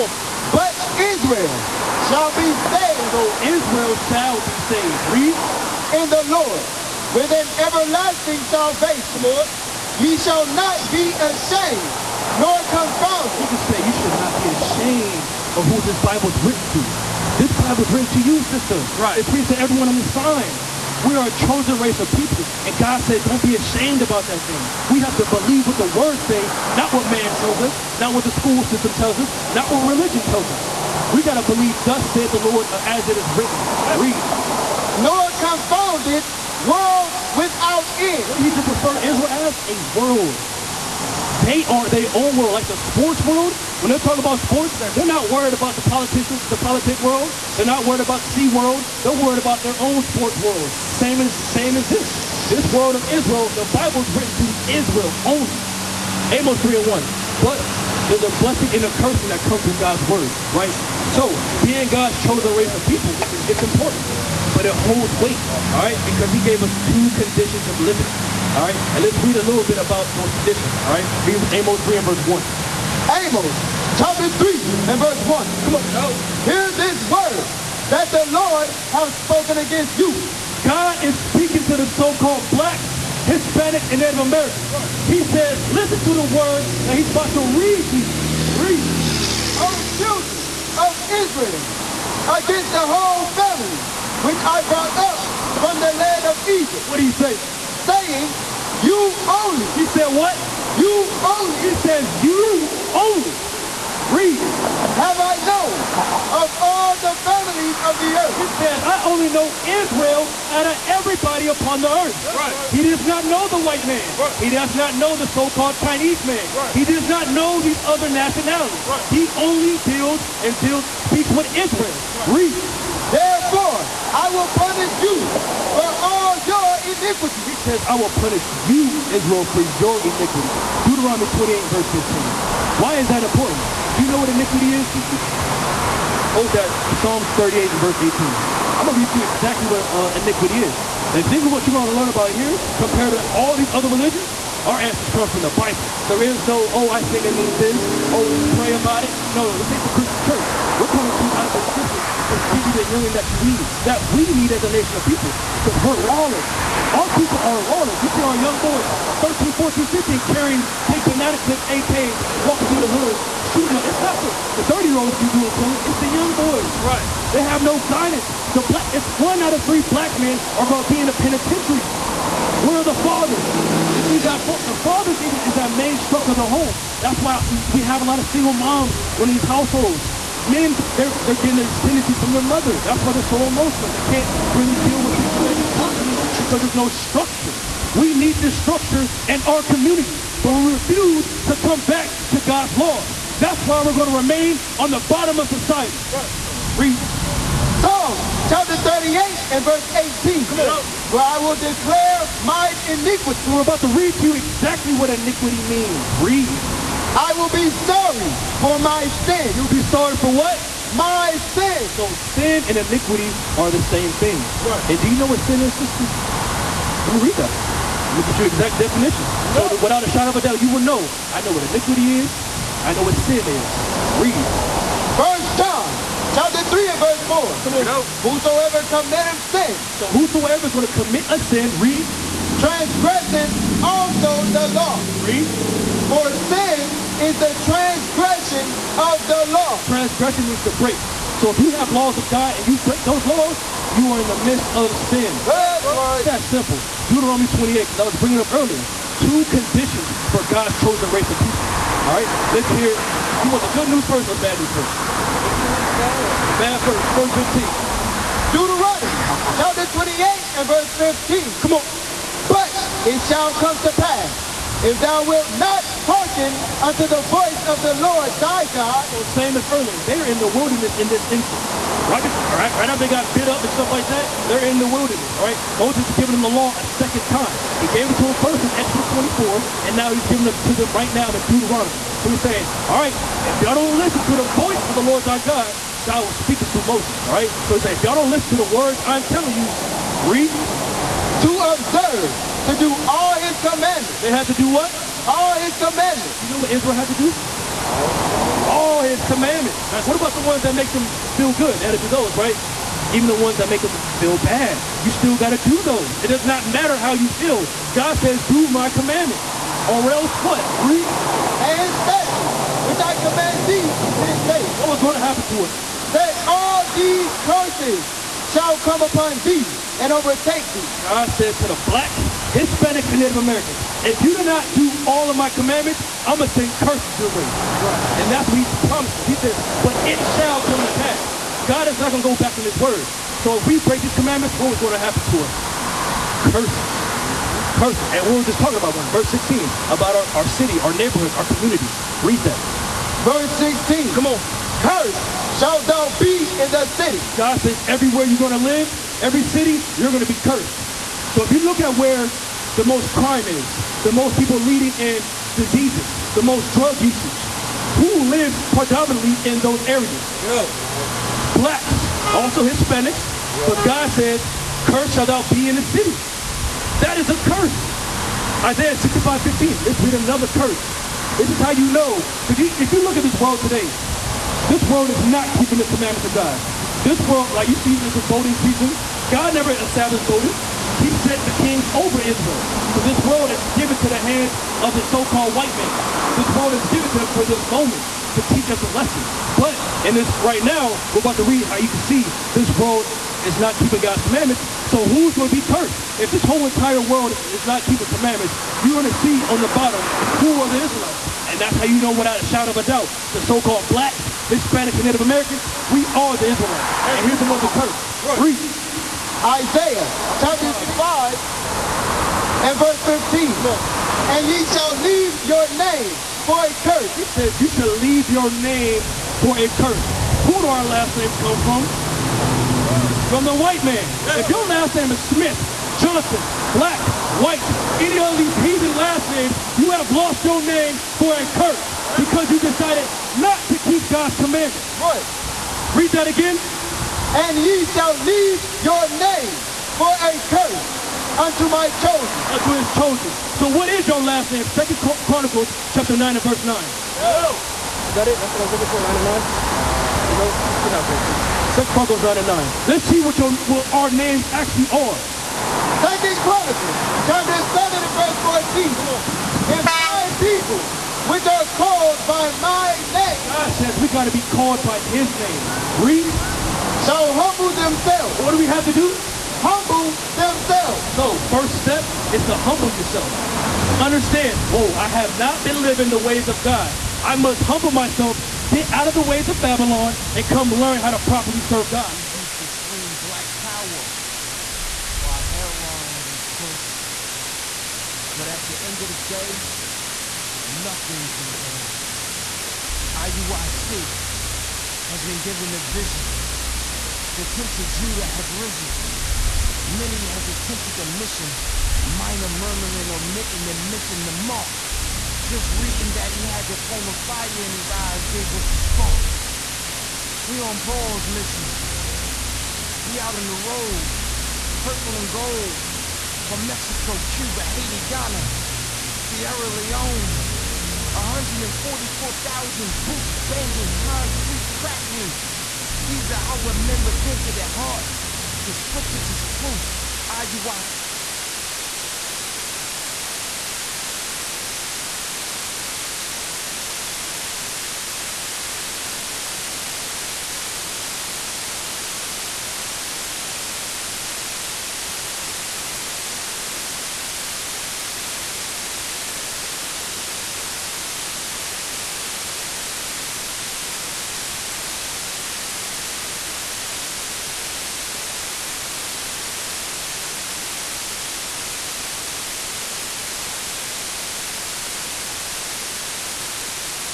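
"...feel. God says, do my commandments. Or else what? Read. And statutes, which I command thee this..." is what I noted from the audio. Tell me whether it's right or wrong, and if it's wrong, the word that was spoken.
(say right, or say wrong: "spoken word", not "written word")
right.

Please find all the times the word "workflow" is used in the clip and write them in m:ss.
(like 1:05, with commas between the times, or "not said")
not said.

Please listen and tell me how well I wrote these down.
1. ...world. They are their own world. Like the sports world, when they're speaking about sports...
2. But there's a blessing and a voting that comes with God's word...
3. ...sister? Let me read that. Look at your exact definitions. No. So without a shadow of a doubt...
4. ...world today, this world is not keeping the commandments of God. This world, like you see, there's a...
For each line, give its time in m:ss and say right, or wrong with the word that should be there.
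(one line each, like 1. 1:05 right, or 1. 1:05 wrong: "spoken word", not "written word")
1. 0:39 wrong: "talking", not "speaking"
2. 0:57 wrong: "cursing", not "voting"
3. 3:35 right
4. 6:13 right.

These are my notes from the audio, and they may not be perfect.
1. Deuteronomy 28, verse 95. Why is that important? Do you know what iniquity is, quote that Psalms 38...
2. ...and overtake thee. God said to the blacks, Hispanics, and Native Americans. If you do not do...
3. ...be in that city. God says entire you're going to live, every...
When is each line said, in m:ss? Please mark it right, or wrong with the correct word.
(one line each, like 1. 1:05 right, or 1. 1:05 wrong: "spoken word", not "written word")
1. 2:10 wrong: "15", not "95"
2. 5:19 right
3. 5:46 wrong: "everywhere", not "entire".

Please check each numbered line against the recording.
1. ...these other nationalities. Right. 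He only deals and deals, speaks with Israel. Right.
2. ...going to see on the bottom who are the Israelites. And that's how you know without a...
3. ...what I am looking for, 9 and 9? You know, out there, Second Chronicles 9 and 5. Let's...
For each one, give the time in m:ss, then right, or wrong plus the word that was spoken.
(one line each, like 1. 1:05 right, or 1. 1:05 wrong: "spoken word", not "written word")
1. 1:57 right
2. 6:38 right
3. 7:28 wrong: "9", not "5".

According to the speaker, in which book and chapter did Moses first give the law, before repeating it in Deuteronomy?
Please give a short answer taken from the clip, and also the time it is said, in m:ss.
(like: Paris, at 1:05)
Exodus 24, at 4:38.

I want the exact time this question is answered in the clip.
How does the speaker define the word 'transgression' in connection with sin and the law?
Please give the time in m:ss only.
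4:00.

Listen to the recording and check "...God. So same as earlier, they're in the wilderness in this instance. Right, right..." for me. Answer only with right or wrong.
right.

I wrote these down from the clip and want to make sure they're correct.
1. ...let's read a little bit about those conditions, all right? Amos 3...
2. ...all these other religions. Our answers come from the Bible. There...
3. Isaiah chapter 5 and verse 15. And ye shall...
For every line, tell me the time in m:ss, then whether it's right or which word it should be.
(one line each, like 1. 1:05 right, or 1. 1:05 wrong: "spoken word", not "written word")
1. 1:09 right
2. 2:23 right
3. 6:49 right.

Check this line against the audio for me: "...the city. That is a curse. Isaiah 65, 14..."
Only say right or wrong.
wrong.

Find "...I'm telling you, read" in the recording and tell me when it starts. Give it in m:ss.
4:49.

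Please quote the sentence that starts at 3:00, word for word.
Men, they're, they're getting these tendencies from their mother.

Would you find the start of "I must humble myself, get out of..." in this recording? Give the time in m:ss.
7:57.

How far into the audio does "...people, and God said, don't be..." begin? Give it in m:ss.
0:22.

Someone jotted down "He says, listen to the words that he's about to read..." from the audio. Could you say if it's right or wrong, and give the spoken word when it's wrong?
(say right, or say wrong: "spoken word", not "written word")
right.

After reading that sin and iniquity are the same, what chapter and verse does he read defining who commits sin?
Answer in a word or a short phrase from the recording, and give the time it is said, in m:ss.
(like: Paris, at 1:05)
Chapter 3 verse 4, at 3:46.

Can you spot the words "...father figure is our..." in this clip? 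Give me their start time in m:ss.
2:54.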